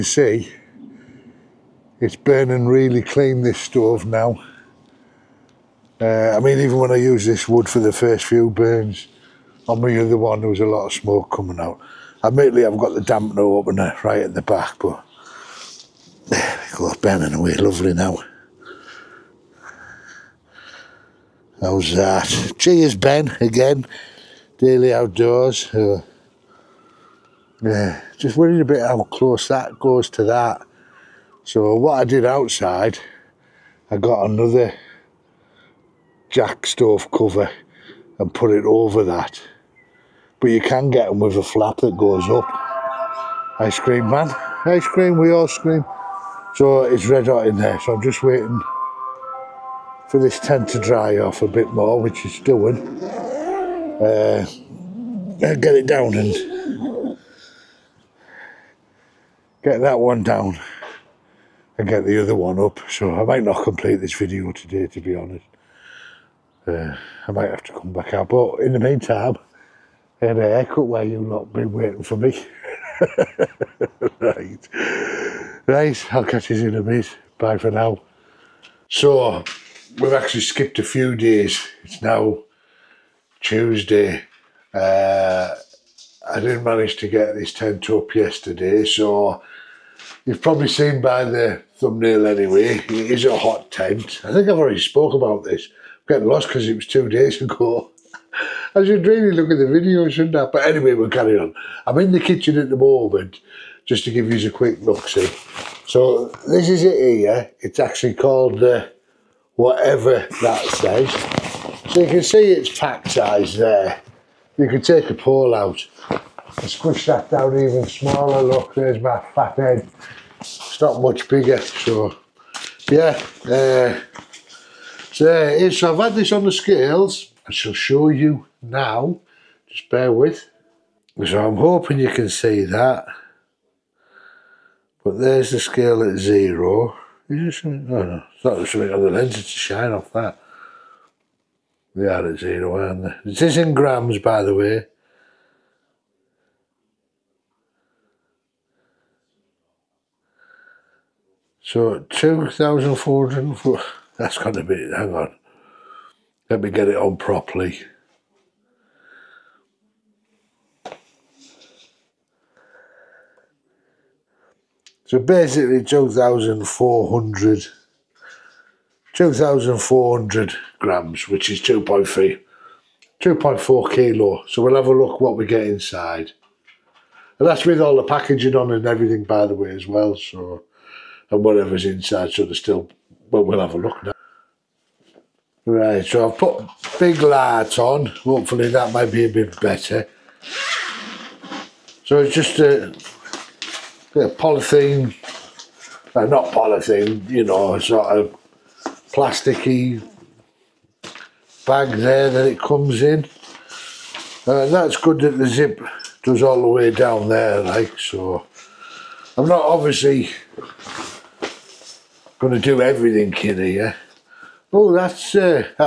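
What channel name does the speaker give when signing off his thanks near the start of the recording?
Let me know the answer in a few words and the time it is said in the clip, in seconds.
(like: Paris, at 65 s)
Daily Outdoors, at 24 s.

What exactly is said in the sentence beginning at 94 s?
I think I've already spoke about this.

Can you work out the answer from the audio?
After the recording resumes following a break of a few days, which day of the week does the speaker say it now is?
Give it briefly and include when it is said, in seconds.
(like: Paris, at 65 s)
Tuesday, at 83 s.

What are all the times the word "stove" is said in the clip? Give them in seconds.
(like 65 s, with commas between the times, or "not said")
3 s, 36 s.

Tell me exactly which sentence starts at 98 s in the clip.
I should really look at the video, shouldn't I?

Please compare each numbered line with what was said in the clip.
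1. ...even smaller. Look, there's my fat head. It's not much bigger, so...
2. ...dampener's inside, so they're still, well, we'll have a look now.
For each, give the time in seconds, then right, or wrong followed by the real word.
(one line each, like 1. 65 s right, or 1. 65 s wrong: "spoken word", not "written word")
1. 117 s right
2. 181 s wrong: "whatever", not "dampener".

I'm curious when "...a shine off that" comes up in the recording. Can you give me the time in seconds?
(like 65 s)
139 s.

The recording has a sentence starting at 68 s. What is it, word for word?
But in the meantime, I had a haircut where you not been waiting for me.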